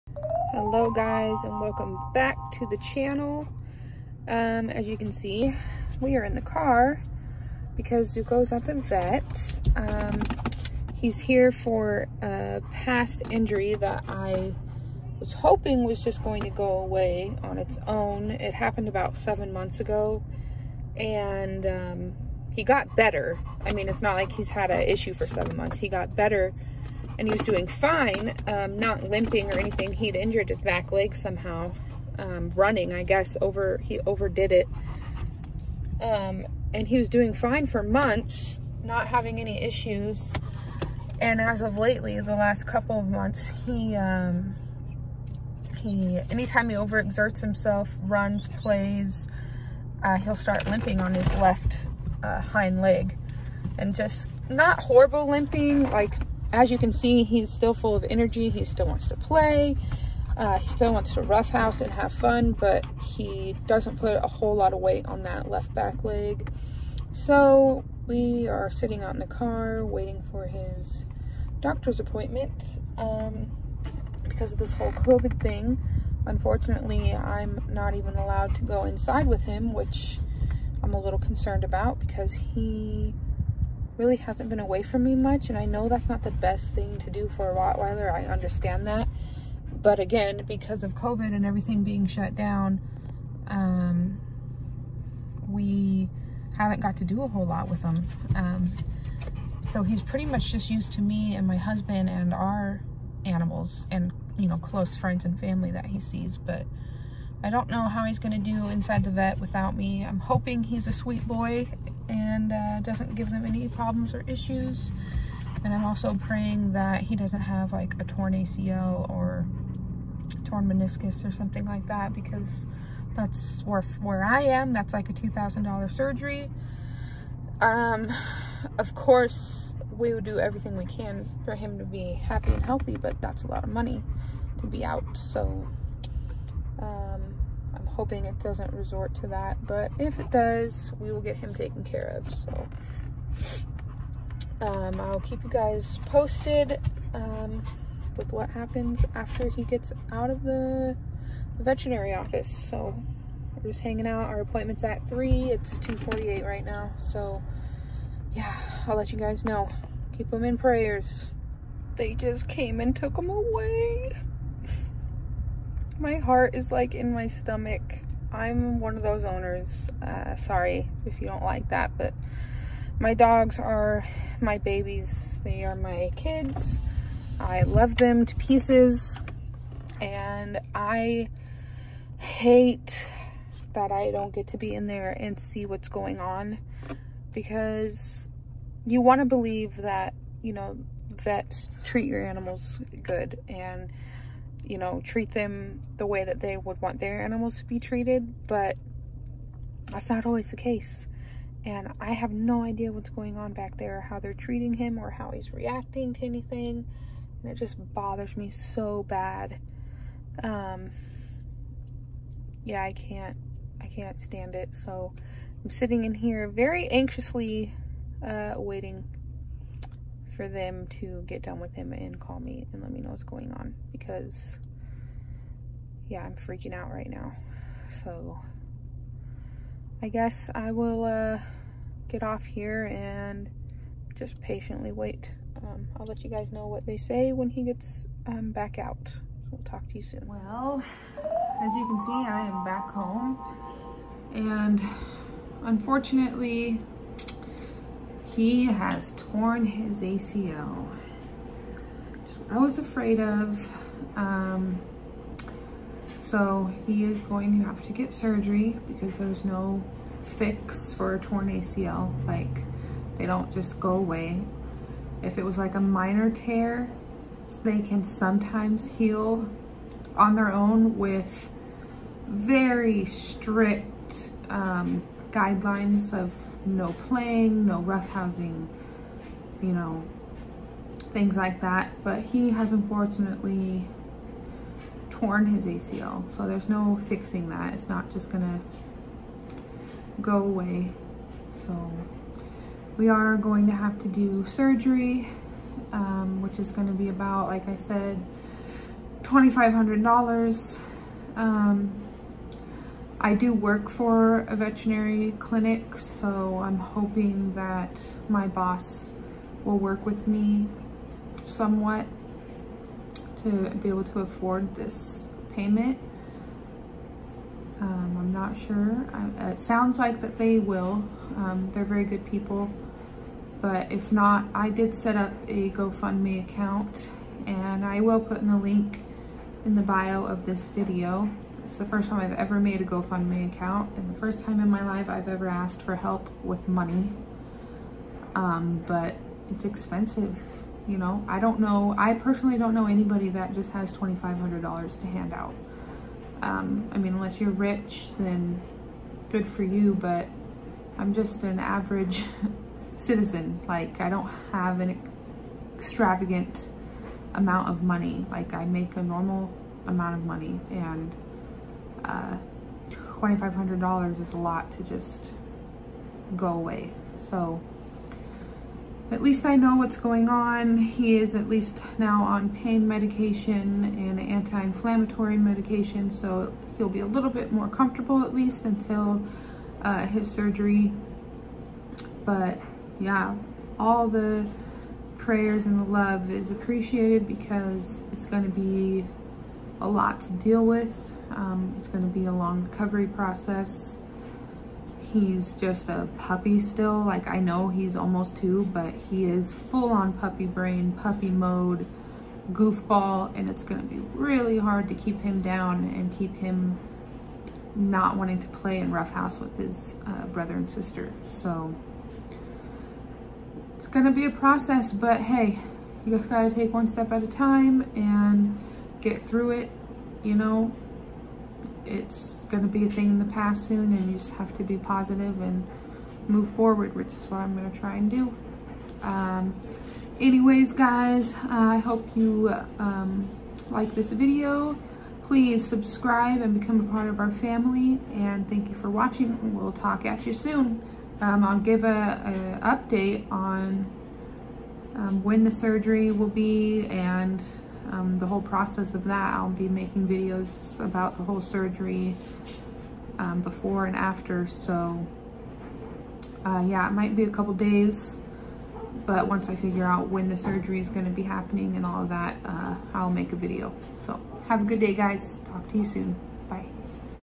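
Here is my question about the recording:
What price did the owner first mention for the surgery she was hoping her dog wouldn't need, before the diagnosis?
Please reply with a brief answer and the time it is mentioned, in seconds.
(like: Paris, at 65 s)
$2,000, at 125 s.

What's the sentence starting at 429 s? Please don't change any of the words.
Um, anyways, guys, uh, I hope you um, like this video.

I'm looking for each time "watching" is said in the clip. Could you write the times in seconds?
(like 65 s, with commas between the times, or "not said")
438 s.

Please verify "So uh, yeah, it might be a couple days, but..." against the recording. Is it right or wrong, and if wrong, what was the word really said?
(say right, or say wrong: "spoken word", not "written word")
right.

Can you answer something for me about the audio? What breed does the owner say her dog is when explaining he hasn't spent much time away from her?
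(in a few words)
Rottweiler.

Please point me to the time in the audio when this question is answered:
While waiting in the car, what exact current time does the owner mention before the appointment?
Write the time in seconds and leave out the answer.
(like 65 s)
155 s.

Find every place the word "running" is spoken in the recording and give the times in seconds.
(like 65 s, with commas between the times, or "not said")
32 s.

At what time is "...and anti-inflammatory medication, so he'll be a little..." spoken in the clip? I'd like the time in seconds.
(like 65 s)
373 s.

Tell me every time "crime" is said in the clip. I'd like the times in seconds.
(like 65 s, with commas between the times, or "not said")
not said.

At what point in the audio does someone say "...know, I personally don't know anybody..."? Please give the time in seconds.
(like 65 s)
341 s.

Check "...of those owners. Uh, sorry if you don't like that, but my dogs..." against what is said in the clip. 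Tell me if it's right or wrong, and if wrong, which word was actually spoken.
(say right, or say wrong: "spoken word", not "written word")
right.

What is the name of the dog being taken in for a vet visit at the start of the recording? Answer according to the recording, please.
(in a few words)
Zuko.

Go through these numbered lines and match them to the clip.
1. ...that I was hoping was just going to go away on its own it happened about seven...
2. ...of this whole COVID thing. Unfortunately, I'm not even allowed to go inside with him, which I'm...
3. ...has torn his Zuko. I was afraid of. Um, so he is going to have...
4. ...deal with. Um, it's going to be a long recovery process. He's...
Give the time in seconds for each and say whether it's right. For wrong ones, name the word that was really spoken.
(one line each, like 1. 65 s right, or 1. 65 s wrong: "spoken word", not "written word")
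1. 13 s right
2. 74 s right
3. 248 s wrong: "ACL", not "Zuko"
4. 390 s right.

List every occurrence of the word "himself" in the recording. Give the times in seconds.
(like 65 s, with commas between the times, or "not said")
47 s.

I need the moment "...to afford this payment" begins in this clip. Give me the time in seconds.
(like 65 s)
314 s.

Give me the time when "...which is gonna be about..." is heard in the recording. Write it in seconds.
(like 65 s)
296 s.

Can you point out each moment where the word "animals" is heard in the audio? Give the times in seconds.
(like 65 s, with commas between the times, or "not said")
103 s, 192 s, 197 s.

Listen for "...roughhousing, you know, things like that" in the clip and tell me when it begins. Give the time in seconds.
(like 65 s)
277 s.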